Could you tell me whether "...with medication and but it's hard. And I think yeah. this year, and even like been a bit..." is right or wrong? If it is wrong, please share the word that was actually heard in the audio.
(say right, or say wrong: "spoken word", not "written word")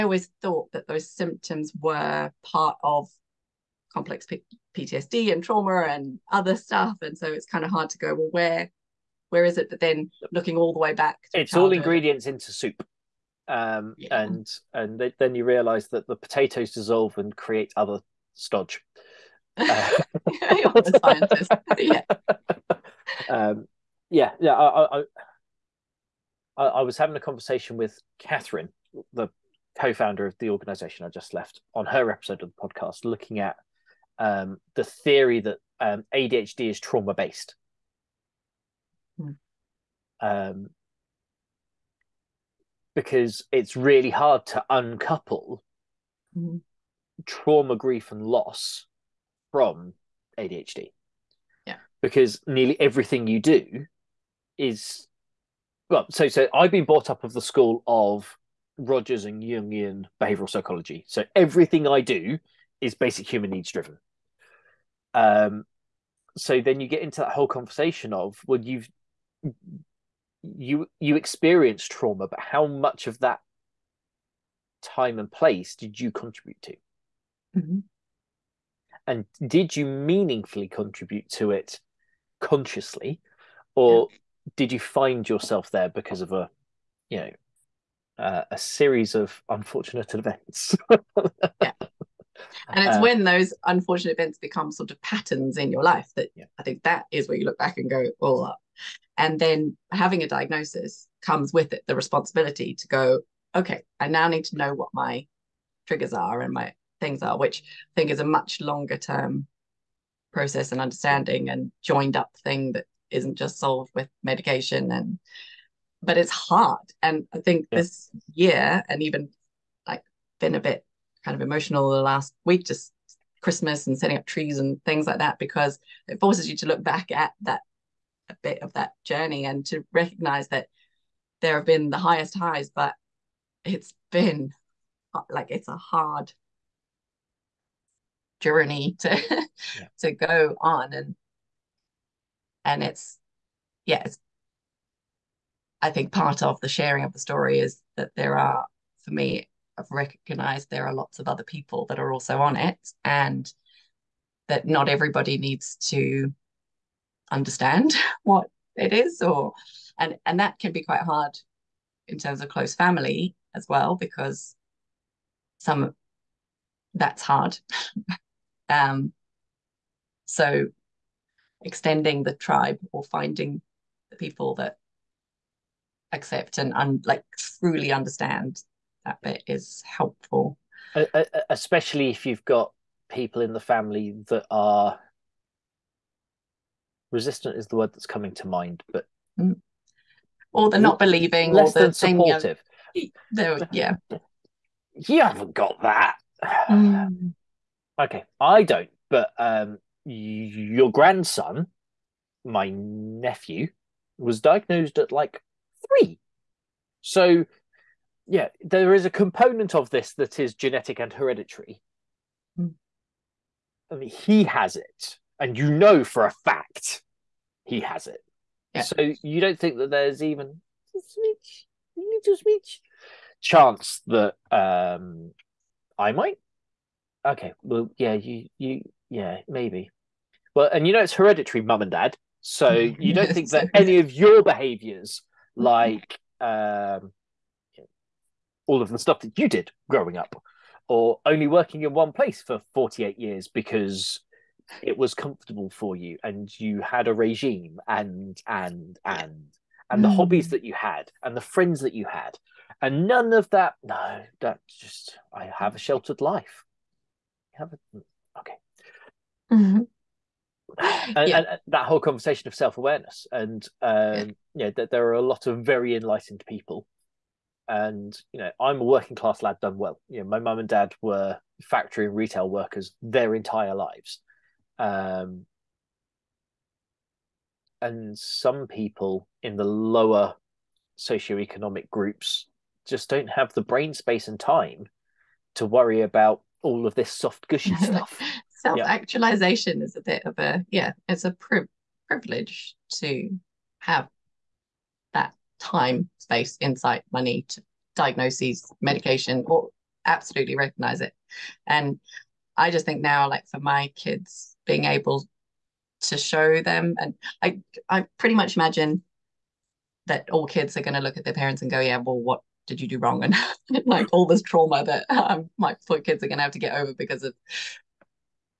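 right.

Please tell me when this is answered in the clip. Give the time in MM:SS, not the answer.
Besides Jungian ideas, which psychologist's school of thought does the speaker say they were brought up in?
00:58.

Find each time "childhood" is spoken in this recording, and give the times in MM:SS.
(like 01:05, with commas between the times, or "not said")
00:11.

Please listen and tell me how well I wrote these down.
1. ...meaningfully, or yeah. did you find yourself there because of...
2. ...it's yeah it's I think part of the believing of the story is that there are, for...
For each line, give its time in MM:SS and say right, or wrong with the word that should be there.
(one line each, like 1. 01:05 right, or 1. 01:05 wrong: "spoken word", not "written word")
1. 01:22 wrong: "consciously", not "meaningfully"
2. 02:22 wrong: "sharing", not "believing".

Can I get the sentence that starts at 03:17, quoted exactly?
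okay i don't but um your grandson my nephew was diagnosed at like three.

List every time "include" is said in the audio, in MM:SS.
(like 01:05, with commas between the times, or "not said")
not said.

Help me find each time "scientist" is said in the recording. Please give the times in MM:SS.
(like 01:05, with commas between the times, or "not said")
00:21.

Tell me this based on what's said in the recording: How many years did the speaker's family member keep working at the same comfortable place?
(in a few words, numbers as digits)
48 years.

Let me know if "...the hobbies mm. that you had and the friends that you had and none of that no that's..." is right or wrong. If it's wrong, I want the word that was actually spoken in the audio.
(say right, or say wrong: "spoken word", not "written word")
right.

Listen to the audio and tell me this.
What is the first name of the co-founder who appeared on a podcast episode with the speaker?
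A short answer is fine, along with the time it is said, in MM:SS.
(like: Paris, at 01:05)
Catherine, at 00:28.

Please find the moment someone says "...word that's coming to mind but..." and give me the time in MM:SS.
03:07.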